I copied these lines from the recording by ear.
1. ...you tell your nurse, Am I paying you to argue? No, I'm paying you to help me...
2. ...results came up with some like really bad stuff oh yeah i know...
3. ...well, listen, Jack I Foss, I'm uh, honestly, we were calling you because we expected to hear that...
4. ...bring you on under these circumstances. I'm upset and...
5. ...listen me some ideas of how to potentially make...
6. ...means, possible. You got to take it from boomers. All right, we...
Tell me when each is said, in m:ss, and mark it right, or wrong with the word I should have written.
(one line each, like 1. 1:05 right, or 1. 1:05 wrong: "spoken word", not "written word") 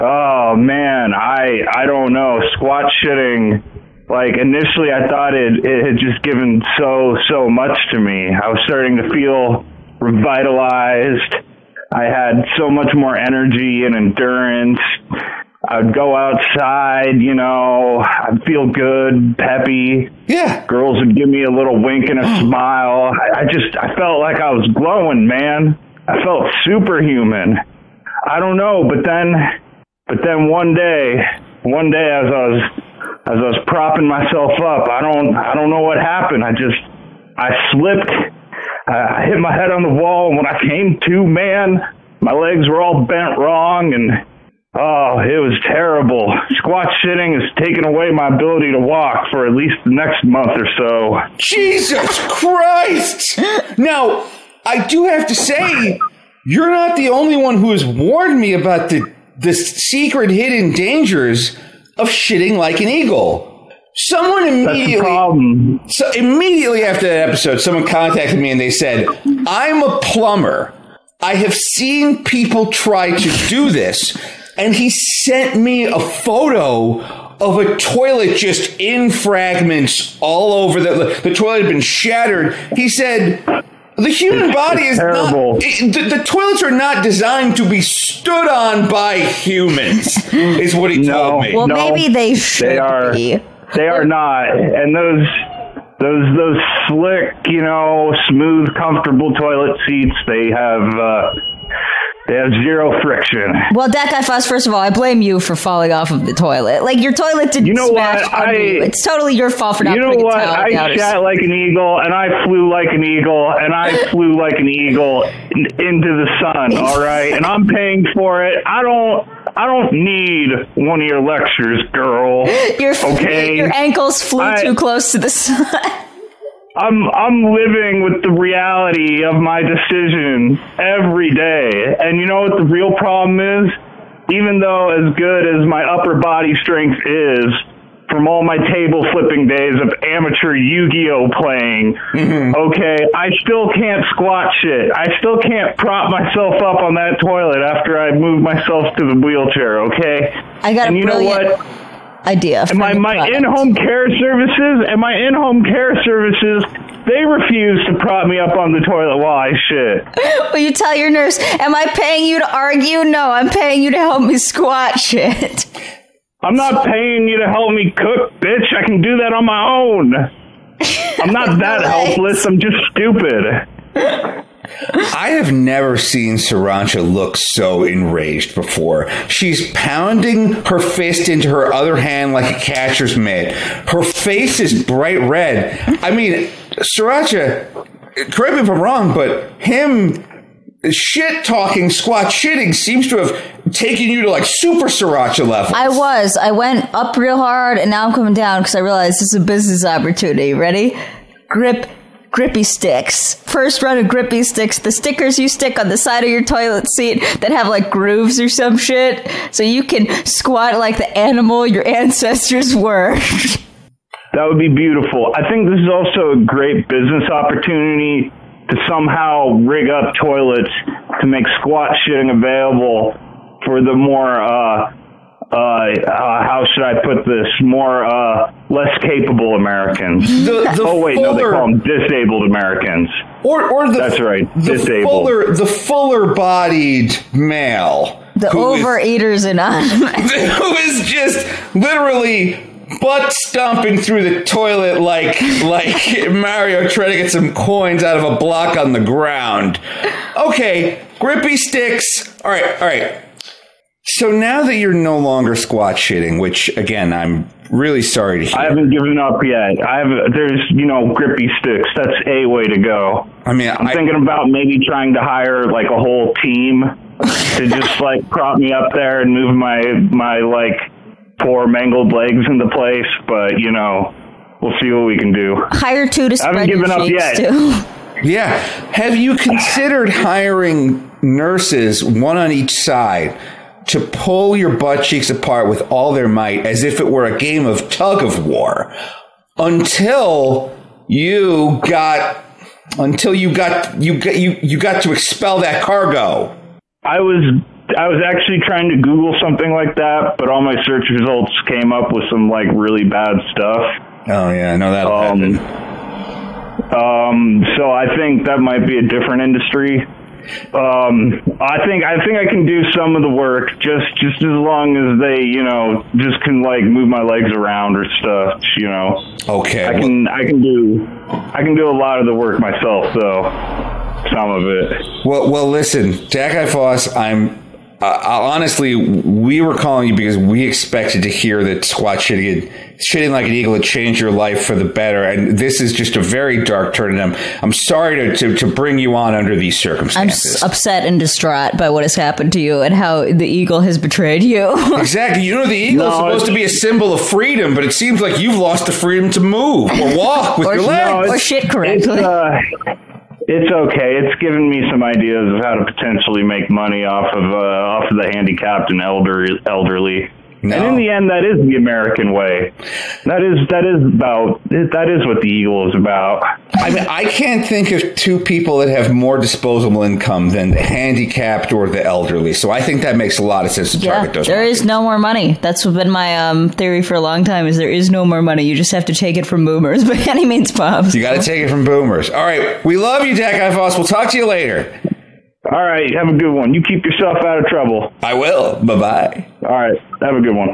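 1. 2:40 right
2. 5:01 right
3. 5:25 right
4. 5:38 right
5. 5:54 wrong: "given", not "listen"
6. 6:20 right.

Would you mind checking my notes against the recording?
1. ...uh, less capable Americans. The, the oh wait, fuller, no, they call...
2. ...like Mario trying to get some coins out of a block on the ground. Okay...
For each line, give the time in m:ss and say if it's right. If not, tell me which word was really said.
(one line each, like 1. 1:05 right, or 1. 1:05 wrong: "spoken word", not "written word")
1. 3:48 right
2. 4:05 right.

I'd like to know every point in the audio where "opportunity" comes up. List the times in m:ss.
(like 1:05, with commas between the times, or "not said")
3:19, 3:37.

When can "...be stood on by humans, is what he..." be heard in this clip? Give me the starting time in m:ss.
1:27.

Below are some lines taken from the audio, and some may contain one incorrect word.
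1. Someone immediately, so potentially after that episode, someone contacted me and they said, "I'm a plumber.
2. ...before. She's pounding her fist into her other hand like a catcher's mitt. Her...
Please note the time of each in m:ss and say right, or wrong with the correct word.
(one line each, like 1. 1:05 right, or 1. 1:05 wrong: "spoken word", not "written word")
1. 1:03 wrong: "immediately", not "potentially"
2. 2:58 right.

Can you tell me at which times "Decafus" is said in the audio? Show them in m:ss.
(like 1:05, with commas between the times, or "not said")
1:43.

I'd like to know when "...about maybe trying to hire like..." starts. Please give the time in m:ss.
4:24.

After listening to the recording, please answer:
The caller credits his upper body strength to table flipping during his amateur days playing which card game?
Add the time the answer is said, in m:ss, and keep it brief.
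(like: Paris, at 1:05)
Yu-Gi-Oh, at 2:20.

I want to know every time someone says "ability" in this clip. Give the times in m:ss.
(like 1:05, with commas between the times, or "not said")
0:48.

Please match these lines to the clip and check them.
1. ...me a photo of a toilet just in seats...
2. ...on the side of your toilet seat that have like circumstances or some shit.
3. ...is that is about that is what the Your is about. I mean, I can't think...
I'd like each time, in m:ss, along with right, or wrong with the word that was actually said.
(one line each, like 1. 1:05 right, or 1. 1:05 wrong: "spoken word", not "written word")
1. 1:15 wrong: "fragments", not "seats"
2. 3:25 wrong: "grooves", not "circumstances"
3. 6:03 wrong: "Eagle", not "Your".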